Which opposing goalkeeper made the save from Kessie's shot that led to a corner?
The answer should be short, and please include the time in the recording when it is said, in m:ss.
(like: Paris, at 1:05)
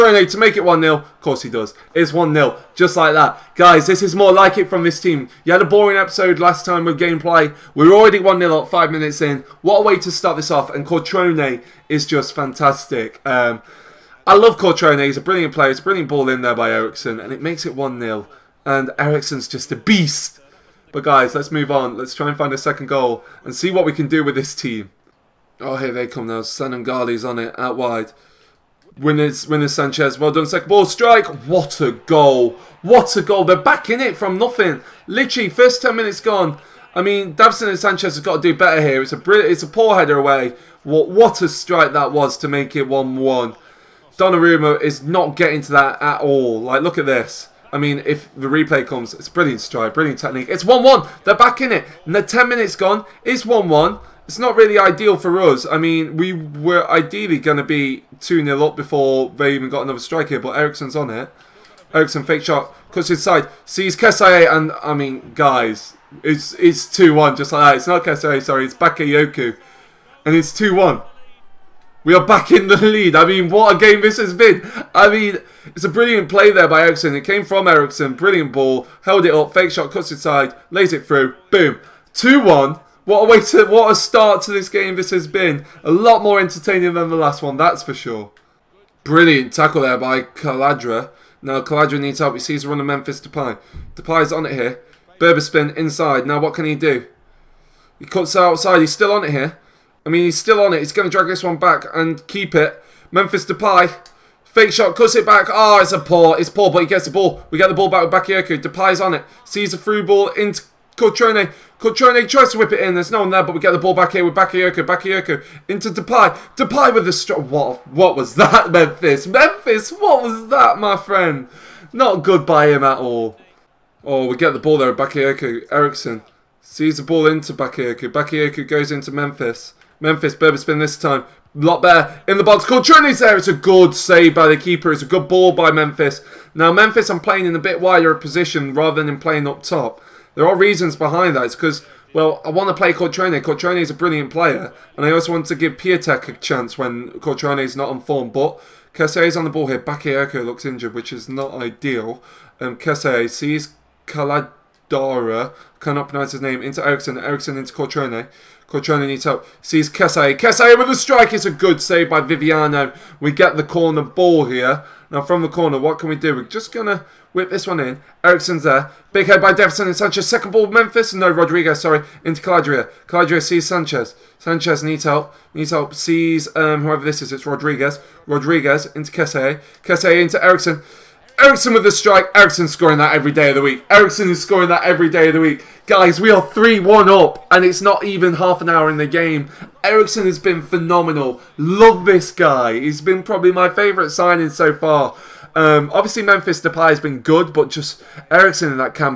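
Viviano, at 2:42.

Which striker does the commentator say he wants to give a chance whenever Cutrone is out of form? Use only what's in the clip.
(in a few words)
Piotek.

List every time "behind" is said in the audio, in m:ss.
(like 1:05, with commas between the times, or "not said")
2:20.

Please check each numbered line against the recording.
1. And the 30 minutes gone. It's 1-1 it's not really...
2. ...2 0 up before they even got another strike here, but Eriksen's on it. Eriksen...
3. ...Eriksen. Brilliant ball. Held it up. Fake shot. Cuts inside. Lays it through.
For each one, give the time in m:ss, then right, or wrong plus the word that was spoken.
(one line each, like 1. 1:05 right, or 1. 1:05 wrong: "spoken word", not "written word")
1. 0:52 wrong: "10", not "30"
2. 0:58 right
3. 1:17 right.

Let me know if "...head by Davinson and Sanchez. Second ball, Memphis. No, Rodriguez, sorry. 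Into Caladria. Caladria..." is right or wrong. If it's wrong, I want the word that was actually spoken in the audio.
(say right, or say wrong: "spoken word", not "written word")
right.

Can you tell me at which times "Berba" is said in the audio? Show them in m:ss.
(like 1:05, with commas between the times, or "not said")
1:35, 2:10.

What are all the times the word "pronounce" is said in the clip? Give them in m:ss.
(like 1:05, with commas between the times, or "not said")
2:36.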